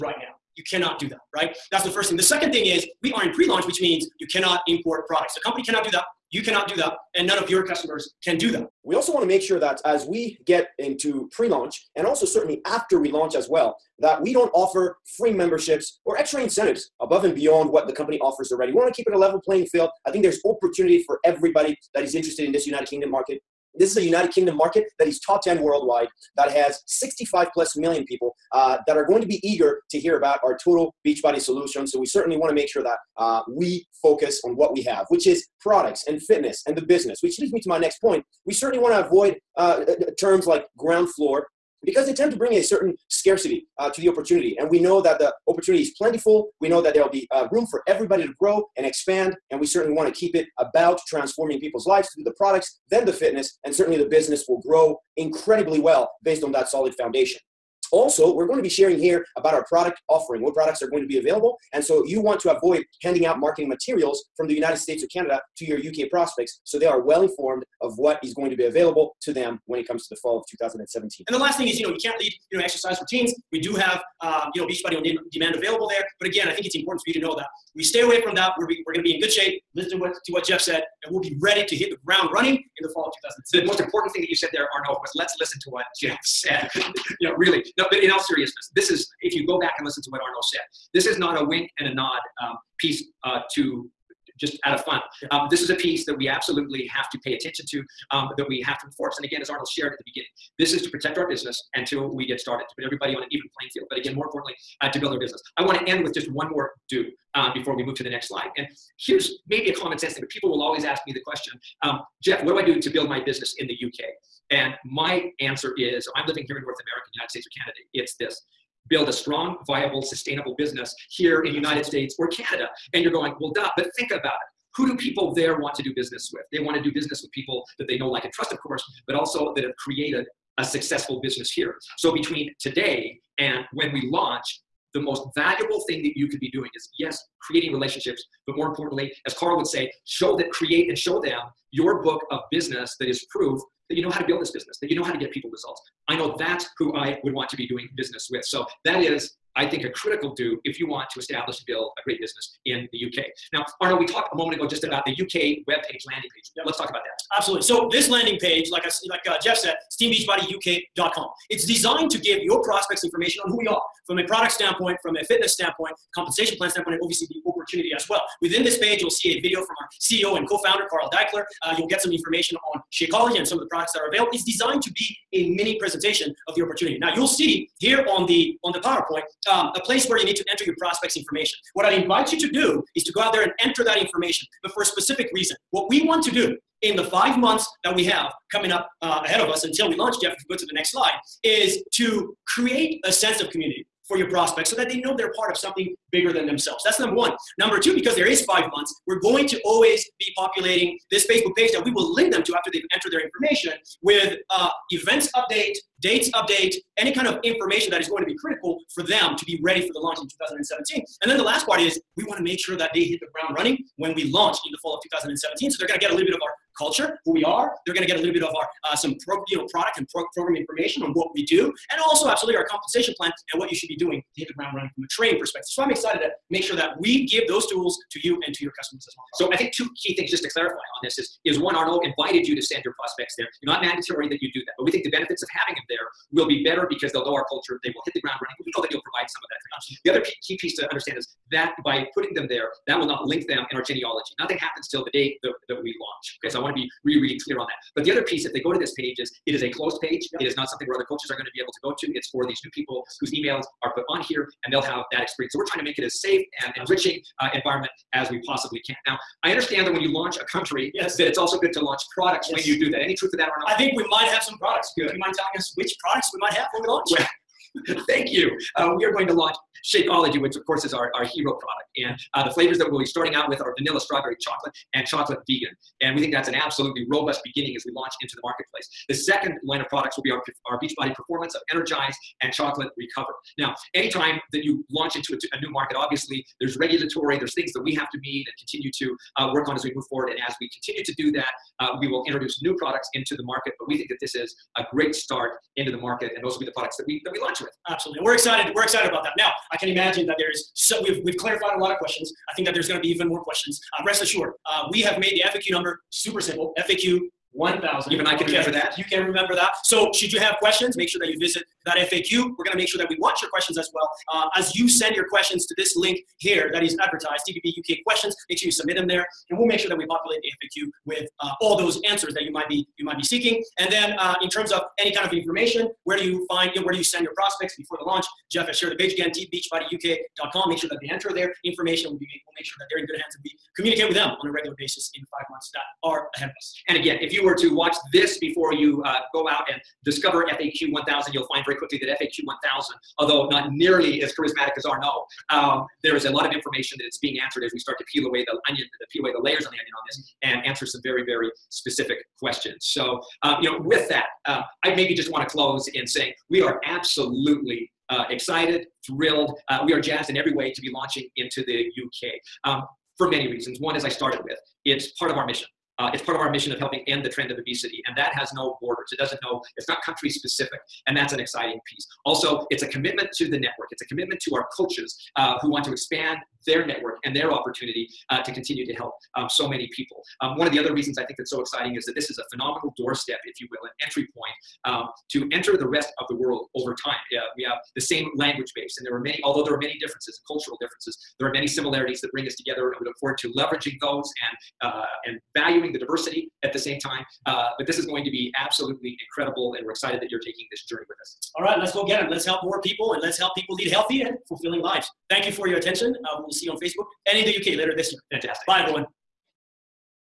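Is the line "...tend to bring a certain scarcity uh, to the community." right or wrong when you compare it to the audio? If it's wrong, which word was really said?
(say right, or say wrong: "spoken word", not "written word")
wrong: "opportunity", not "community".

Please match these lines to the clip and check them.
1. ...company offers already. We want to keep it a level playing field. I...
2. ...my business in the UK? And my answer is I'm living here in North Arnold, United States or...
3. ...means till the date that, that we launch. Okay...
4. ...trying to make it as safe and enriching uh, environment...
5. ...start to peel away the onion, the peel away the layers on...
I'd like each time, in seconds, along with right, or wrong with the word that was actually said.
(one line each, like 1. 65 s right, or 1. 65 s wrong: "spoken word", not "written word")
1. 17 s right
2. 113 s wrong: "America", not "Arnold"
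3. 244 s wrong: "happens", not "means"
4. 255 s right
5. 347 s right.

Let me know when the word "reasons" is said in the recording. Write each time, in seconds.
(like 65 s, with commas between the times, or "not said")
185 s, 363 s, 380 s.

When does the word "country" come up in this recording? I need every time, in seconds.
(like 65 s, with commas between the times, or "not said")
260 s, 370 s.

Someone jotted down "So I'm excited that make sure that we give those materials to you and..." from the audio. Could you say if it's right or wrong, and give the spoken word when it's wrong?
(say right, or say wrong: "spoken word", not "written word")
wrong: "tools", not "materials".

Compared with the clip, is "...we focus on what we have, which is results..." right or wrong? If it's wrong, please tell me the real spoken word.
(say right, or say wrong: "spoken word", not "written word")
wrong: "products", not "results".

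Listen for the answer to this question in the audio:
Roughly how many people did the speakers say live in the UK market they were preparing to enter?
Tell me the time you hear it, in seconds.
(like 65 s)
26 s.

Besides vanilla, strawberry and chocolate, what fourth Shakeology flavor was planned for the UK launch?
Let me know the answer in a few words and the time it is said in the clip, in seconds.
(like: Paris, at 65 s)
chocolate vegan, at 275 s.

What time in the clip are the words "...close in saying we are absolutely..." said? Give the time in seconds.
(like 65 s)
355 s.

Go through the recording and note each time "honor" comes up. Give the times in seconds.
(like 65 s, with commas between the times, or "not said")
not said.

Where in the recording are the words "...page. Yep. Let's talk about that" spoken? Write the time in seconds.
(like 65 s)
156 s.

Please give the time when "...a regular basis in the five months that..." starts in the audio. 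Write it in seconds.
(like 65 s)
334 s.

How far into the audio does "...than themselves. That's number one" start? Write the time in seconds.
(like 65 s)
196 s.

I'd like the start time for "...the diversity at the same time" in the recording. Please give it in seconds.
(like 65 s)
395 s.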